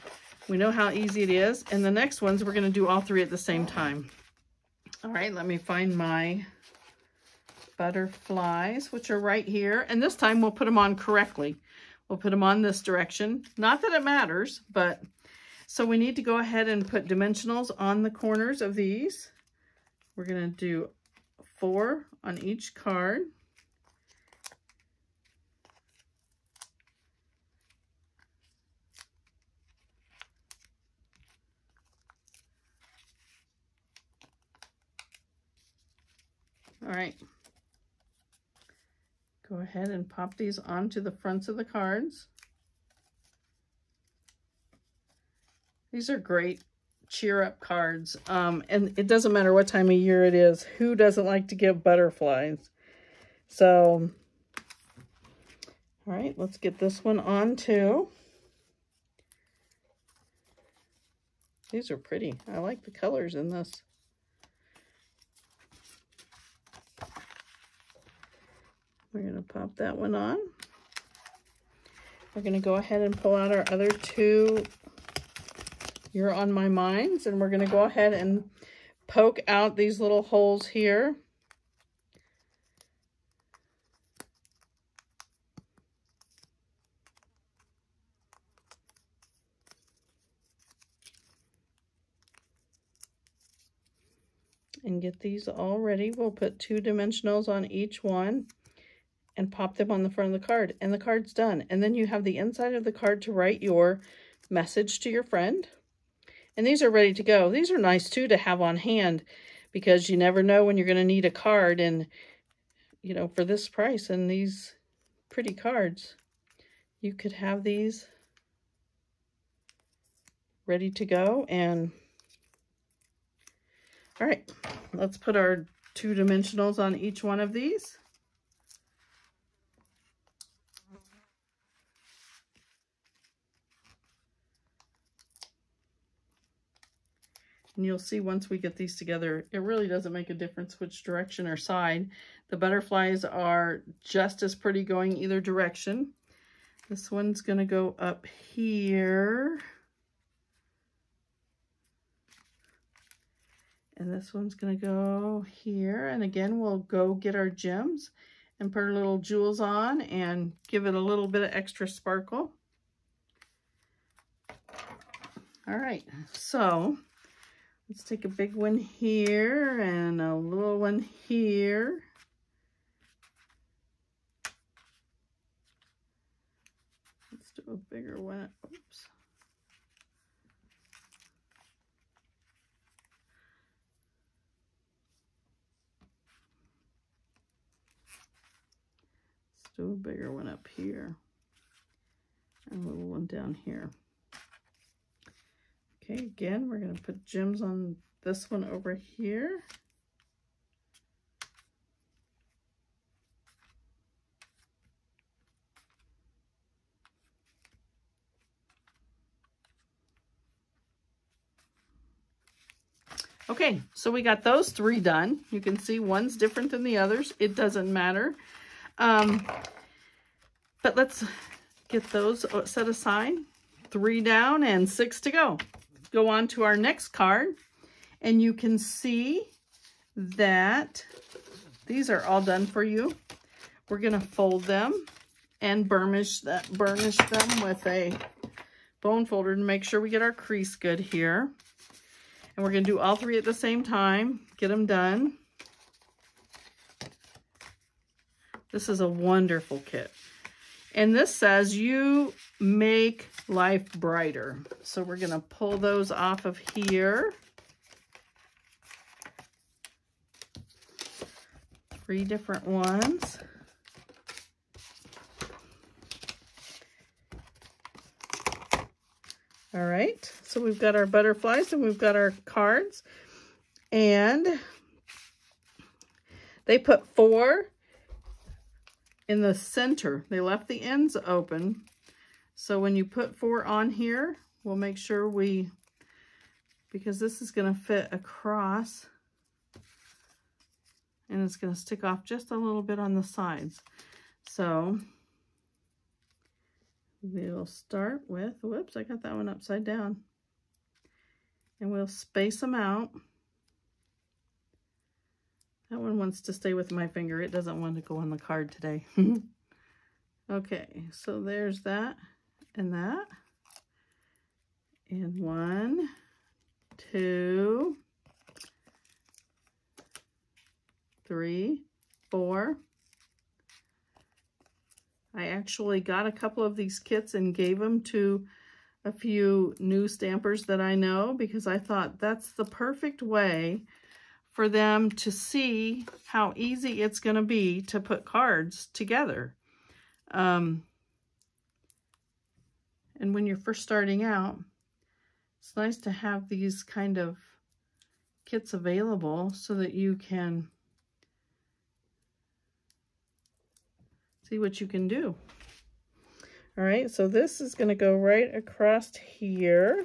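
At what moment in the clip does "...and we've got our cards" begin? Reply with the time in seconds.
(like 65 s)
271 s.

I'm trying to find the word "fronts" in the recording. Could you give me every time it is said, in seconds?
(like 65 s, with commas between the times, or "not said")
41 s, 100 s.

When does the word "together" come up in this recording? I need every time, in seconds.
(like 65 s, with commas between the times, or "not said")
138 s, 338 s.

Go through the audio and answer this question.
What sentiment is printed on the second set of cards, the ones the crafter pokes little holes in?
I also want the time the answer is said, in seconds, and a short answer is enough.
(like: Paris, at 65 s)
You're On My Minds, at 76 s.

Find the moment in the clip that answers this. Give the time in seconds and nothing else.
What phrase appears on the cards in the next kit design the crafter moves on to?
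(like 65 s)
251 s.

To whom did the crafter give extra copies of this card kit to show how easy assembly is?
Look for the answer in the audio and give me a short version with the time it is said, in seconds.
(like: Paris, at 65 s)
New stampers, at 329 s.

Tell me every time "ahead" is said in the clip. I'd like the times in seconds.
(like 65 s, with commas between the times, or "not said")
16 s, 39 s, 72 s, 77 s.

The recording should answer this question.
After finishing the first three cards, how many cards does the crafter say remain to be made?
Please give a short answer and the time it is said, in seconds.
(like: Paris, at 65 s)
6, at 224 s.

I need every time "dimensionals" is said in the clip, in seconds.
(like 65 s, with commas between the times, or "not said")
17 s, 96 s, 126 s.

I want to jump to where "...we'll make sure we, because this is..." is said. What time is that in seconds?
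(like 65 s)
284 s.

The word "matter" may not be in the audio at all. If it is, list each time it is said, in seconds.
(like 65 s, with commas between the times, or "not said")
14 s, 49 s, 217 s.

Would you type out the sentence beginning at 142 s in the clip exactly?
The butterflies are just as pretty going either direction.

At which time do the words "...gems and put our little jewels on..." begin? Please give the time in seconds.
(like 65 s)
157 s.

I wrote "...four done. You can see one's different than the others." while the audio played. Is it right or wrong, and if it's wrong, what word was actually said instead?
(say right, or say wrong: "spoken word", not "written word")
wrong: "three", not "four".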